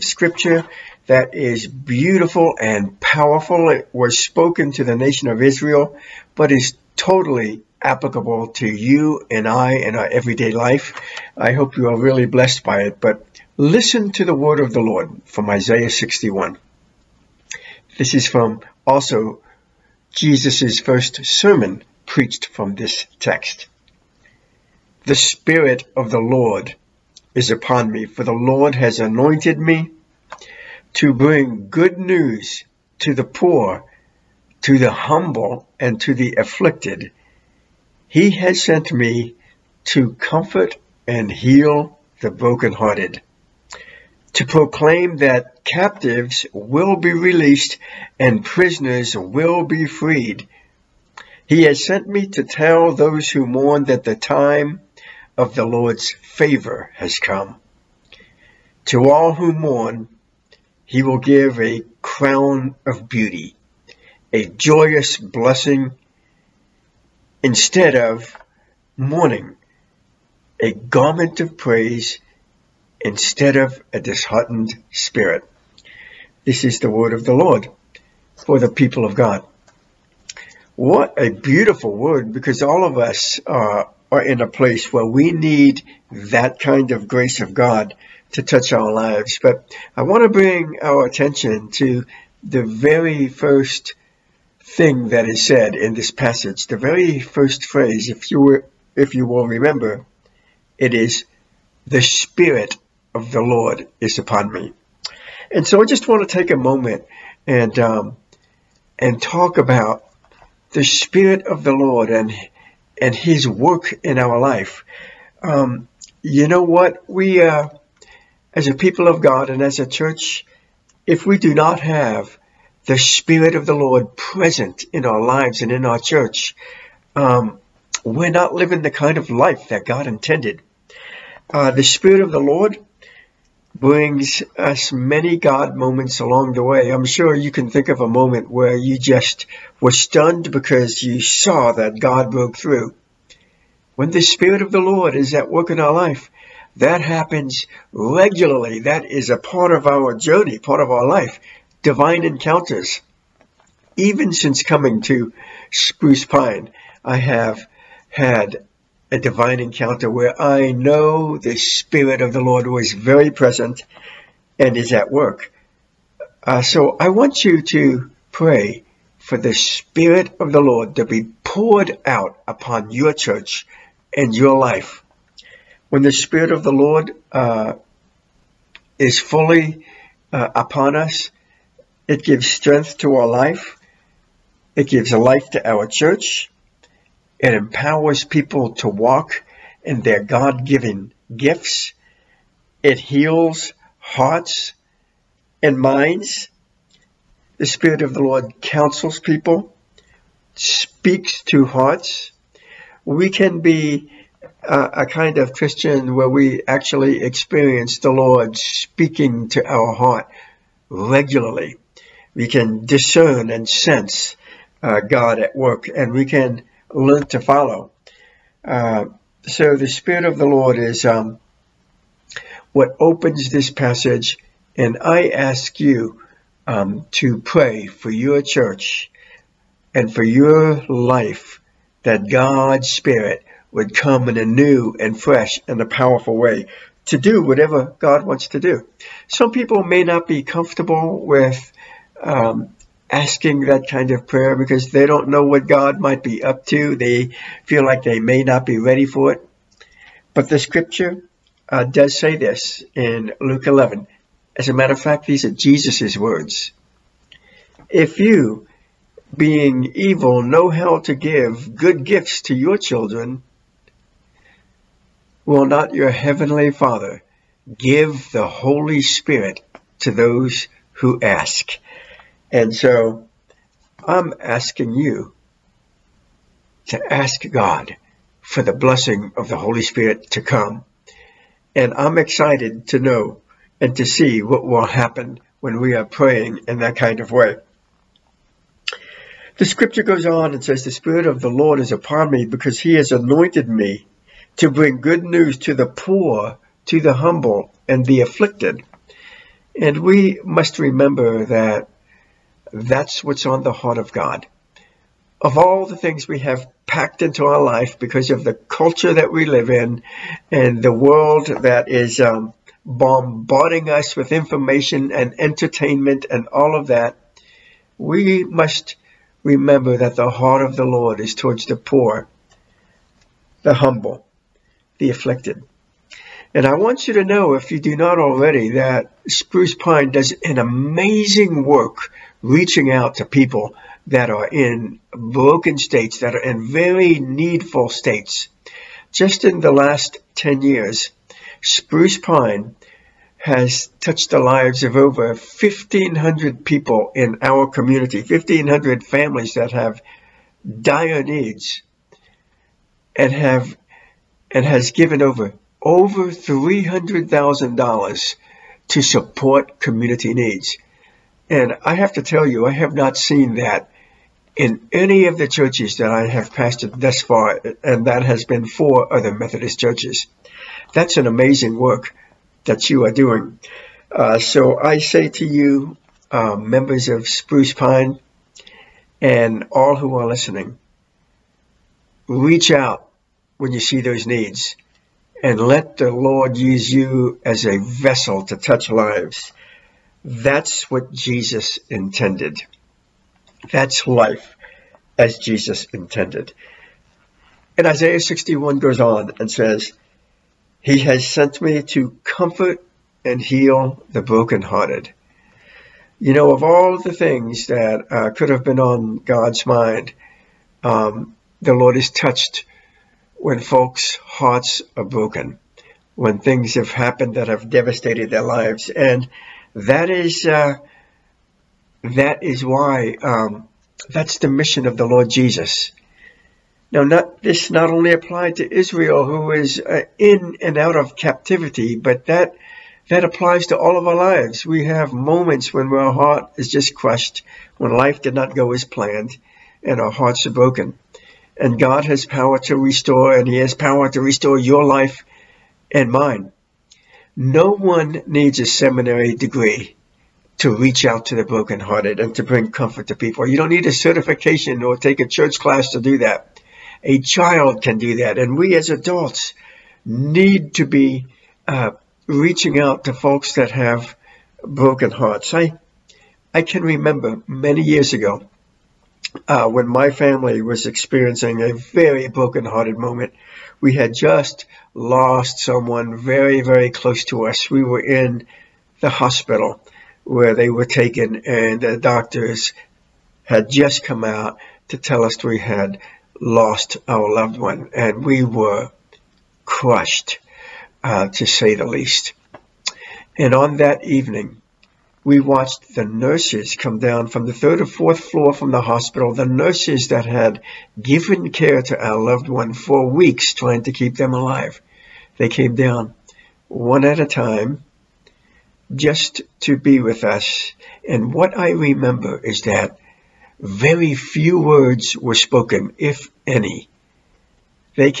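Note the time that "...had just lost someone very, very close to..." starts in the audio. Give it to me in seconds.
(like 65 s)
473 s.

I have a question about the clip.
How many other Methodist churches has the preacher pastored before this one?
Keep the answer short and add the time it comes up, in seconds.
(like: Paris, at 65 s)
4, at 368 s.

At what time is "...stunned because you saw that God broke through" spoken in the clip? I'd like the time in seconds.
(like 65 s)
139 s.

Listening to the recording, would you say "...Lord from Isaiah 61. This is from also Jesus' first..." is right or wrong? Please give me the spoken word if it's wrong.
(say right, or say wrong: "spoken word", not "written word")
right.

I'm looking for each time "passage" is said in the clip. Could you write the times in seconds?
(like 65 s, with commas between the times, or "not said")
96 s, 223 s.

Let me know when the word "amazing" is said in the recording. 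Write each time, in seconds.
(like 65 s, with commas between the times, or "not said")
330 s, 371 s.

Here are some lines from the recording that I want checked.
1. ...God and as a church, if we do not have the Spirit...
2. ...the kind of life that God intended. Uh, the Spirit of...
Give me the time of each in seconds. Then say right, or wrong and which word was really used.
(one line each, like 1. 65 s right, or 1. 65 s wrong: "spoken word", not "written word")
1. 119 s right
2. 128 s right.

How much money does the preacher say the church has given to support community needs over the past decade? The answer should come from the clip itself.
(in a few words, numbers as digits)
$300,000.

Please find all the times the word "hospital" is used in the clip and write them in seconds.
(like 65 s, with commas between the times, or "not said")
479 s, 498 s.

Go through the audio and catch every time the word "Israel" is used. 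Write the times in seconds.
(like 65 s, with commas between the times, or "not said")
5 s, 428 s.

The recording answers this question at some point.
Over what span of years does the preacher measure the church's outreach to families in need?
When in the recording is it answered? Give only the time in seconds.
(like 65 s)
340 s.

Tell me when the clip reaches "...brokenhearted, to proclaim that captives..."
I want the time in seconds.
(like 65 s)
42 s.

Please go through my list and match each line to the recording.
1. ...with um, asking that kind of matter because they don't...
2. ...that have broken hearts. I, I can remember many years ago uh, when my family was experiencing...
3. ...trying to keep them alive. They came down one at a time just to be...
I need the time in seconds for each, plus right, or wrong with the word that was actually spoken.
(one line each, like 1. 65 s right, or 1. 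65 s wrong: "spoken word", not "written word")
1. 241 s wrong: "prayer", not "matter"
2. 463 s right
3. 503 s right.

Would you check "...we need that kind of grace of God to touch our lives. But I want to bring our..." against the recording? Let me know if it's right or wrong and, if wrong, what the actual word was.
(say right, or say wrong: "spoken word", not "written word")
right.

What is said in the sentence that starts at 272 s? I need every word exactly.
And so I'm asking you to ask God for the blessing of the Holy Spirit to come.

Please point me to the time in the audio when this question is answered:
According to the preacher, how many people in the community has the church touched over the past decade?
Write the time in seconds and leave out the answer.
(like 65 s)
345 s.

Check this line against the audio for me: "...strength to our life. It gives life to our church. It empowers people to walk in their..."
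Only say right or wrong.
right.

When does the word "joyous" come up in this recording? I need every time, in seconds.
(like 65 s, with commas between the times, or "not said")
64 s.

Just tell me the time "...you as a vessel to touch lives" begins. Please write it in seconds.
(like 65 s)
386 s.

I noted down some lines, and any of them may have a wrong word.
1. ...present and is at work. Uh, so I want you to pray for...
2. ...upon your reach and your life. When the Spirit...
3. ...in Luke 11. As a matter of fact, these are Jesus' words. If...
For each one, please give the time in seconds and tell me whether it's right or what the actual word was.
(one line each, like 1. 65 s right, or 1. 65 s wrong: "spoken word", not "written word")
1. 163 s right
2. 172 s wrong: "church", not "reach"
3. 252 s right.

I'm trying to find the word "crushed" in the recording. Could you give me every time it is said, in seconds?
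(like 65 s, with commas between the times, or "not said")
436 s, 489 s.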